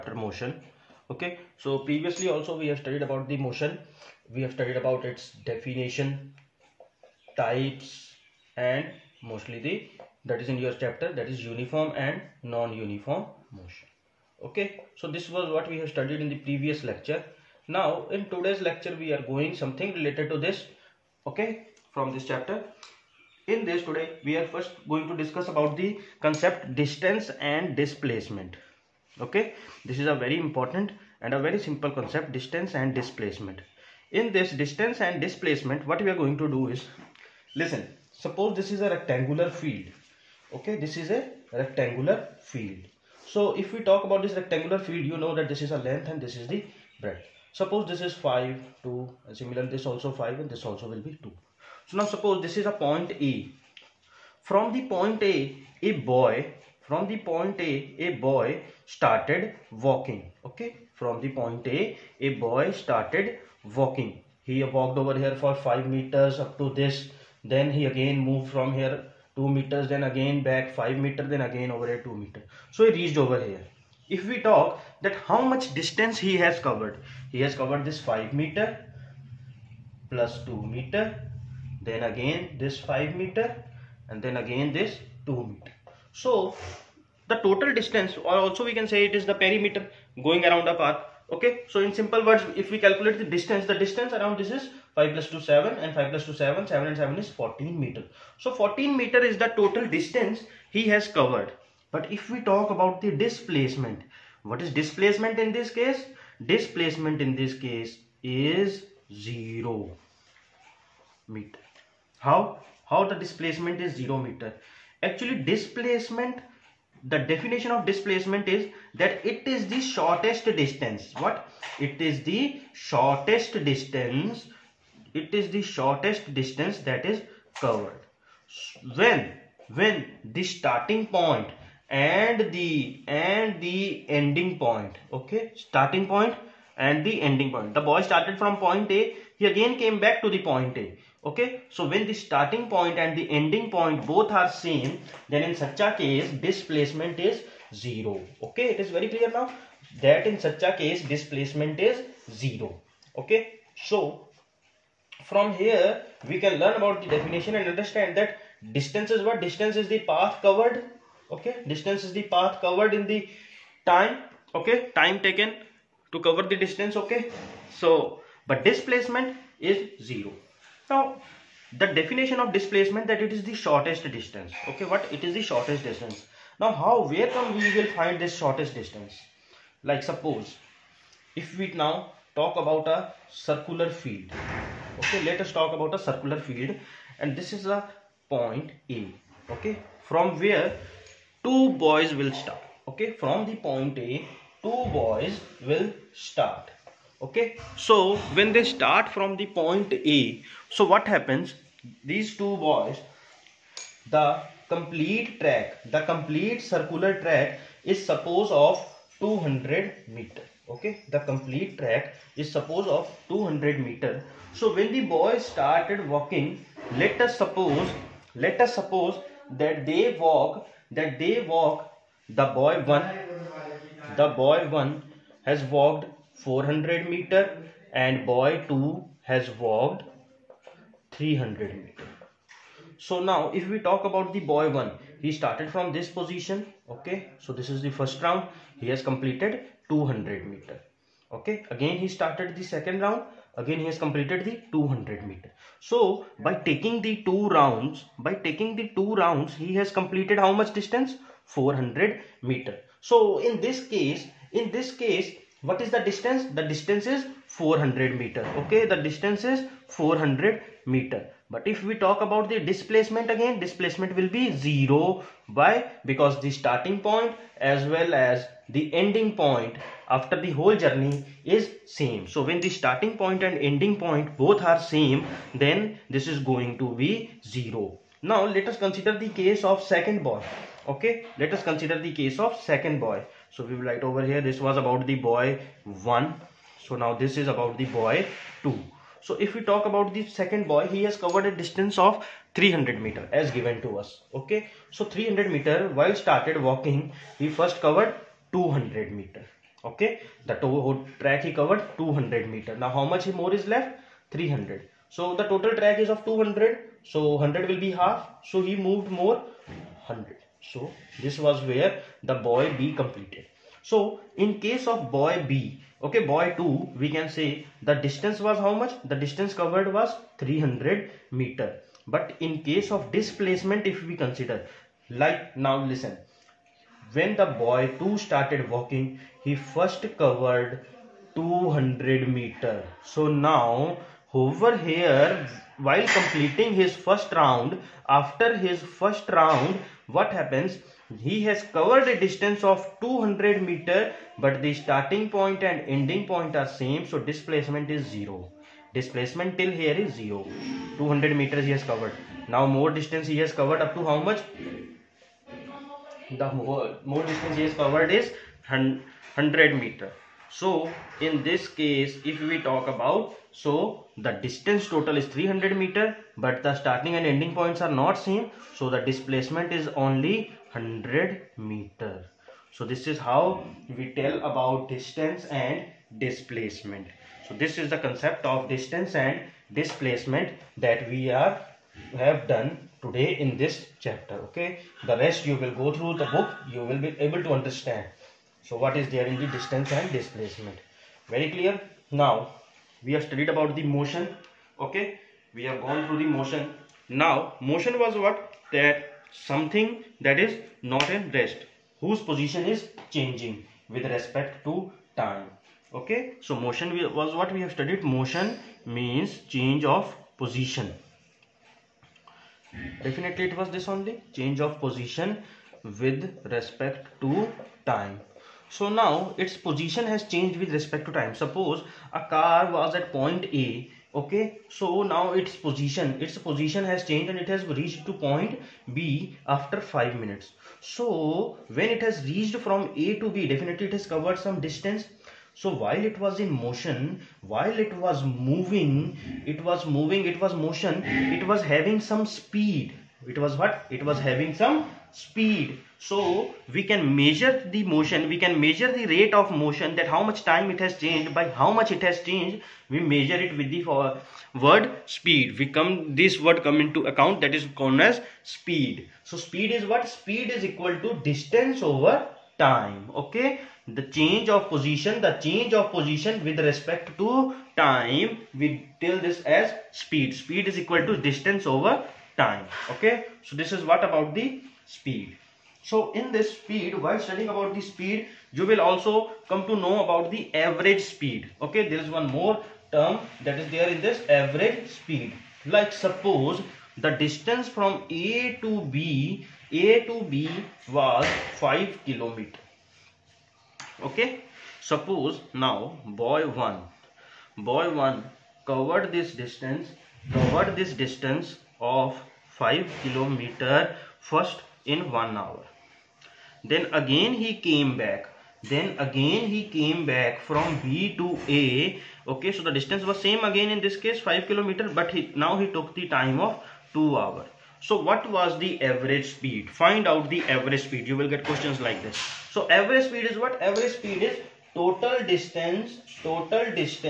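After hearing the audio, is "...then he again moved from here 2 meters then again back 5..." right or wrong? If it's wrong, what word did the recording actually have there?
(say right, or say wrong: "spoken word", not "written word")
right.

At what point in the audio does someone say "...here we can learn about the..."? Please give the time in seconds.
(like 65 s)
155 s.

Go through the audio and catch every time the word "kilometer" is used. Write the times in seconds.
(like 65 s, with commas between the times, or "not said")
492 s, 503 s, 514 s.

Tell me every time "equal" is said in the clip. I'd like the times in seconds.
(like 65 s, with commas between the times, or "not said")
460 s, 470 s.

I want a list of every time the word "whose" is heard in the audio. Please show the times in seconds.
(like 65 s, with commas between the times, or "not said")
402 s.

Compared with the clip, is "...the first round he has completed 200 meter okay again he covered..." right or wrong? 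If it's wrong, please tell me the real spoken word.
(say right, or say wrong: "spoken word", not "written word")
wrong: "started", not "covered".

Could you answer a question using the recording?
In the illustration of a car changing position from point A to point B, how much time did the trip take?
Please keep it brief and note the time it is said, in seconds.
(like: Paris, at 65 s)
5 minutes, at 429 s.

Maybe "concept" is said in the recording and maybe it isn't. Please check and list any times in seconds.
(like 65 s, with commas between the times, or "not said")
26 s, 31 s, 377 s.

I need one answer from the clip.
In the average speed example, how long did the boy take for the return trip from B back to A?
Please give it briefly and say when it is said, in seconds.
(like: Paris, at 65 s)
2 hours, at 516 s.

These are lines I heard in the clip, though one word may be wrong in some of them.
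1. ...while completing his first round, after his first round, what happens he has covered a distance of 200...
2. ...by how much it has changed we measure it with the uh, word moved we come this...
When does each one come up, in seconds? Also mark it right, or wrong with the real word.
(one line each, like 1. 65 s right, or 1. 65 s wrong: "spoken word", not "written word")
1. 335 s right
2. 451 s wrong: "speed", not "moved".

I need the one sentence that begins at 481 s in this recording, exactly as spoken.
Okay, there is one more term that is there in this average speed.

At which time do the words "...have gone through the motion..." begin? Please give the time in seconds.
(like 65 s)
395 s.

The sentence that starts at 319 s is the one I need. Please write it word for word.
The distance covered was 300 meter.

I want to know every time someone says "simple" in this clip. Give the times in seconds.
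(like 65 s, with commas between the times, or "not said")
31 s, 91 s.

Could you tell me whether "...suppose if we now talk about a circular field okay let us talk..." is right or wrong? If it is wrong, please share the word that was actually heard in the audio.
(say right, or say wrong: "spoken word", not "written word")
right.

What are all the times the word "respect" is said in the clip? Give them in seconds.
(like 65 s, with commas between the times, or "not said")
404 s, 416 s, 420 s, 466 s.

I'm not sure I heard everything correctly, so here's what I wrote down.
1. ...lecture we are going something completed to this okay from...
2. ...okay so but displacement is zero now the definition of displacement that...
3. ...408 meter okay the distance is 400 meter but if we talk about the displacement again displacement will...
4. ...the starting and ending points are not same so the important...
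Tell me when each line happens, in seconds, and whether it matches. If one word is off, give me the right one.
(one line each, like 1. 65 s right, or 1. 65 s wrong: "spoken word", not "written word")
1. 18 s wrong: "related", not "completed"
2. 166 s right
3. 257 s wrong: "400", not "408"
4. 366 s wrong: "displacement", not "important".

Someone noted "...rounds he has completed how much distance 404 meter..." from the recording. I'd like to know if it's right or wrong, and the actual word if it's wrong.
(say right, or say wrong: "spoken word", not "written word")
wrong: "400", not "404".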